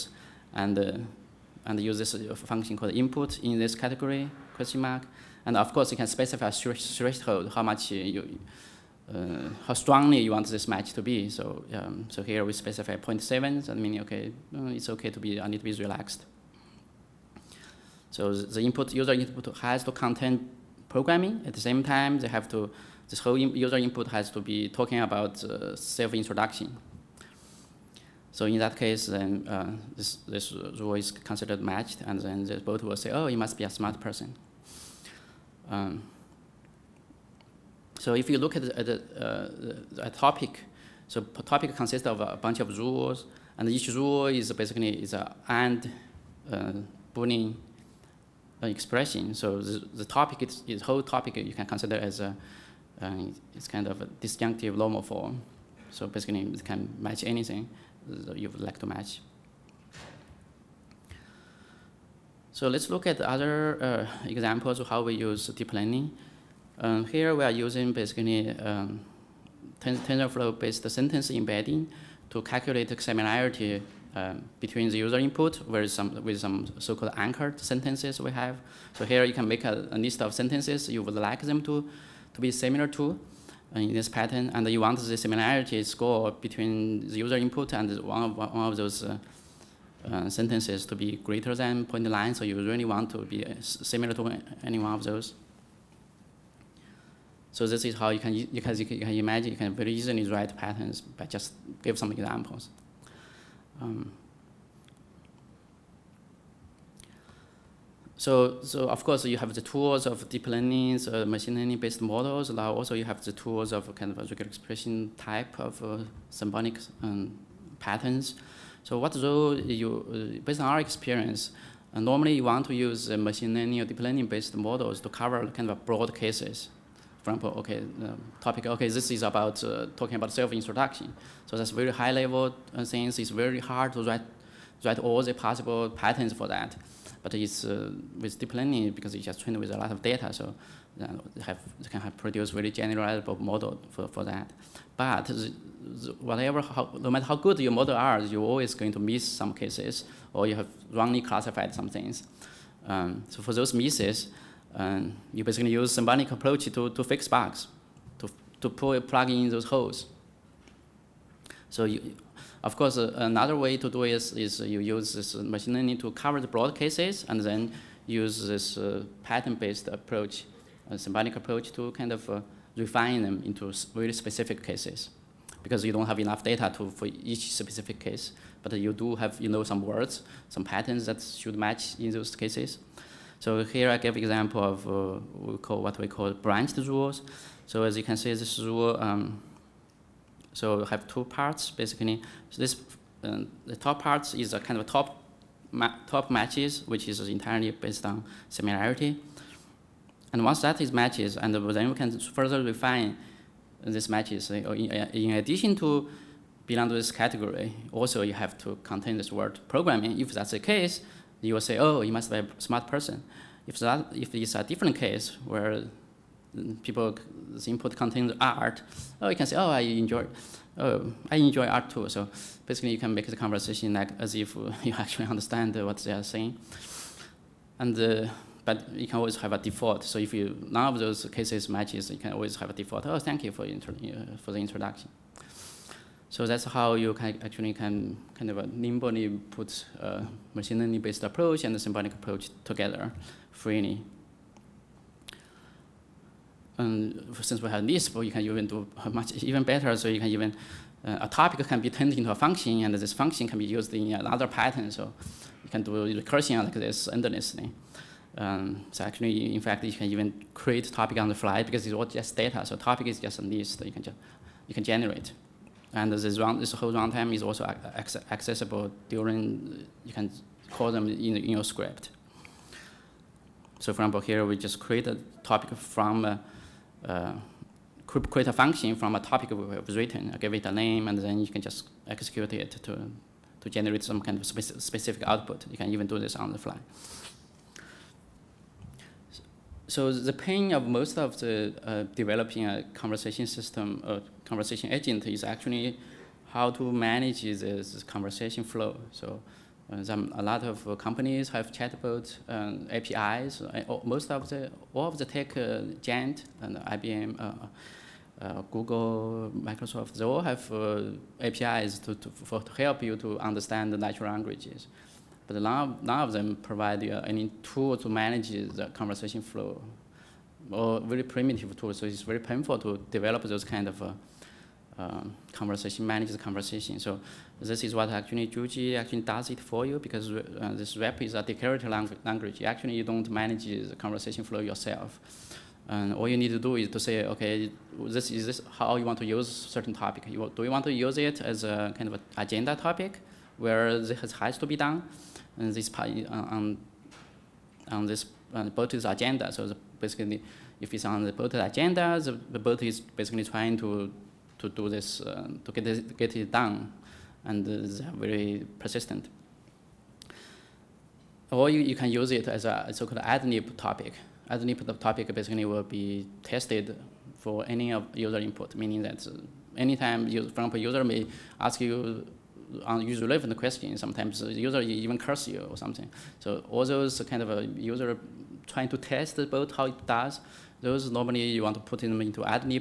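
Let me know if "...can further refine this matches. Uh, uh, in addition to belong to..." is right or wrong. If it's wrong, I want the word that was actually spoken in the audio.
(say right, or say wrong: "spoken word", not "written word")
right.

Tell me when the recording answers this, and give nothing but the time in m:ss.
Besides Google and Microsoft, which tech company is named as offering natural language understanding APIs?
5:06.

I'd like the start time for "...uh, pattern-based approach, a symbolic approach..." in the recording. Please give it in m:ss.
2:48.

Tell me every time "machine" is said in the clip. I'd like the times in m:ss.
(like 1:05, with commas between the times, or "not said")
1:51, 2:03, 2:45, 4:00.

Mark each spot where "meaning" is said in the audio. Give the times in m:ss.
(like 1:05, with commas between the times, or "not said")
0:13, 6:08.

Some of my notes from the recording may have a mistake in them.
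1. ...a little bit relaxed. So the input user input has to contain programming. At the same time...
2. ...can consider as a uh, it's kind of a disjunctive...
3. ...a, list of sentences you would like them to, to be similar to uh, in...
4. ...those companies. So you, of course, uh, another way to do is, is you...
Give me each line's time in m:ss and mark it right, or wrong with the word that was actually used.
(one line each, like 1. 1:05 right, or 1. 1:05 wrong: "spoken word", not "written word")
1. 0:15 right
2. 0:51 right
3. 1:19 right
4. 2:39 wrong: "holes", not "companies".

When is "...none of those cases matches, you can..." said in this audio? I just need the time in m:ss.
3:50.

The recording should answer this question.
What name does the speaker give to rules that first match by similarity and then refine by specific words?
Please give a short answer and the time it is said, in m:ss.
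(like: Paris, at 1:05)
Branched rules, at 3:06.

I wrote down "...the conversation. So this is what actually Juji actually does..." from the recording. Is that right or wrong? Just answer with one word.
right.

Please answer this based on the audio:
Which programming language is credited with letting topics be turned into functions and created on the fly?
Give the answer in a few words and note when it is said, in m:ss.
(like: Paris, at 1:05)
Lisp, at 4:07.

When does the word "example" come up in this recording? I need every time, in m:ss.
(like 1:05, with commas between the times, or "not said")
1:04, 1:42, 2:07, 3:04, 4:34, 6:10.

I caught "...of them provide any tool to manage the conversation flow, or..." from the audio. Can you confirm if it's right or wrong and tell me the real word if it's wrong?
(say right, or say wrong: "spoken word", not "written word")
right.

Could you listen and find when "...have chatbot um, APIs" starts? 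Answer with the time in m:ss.
5:01.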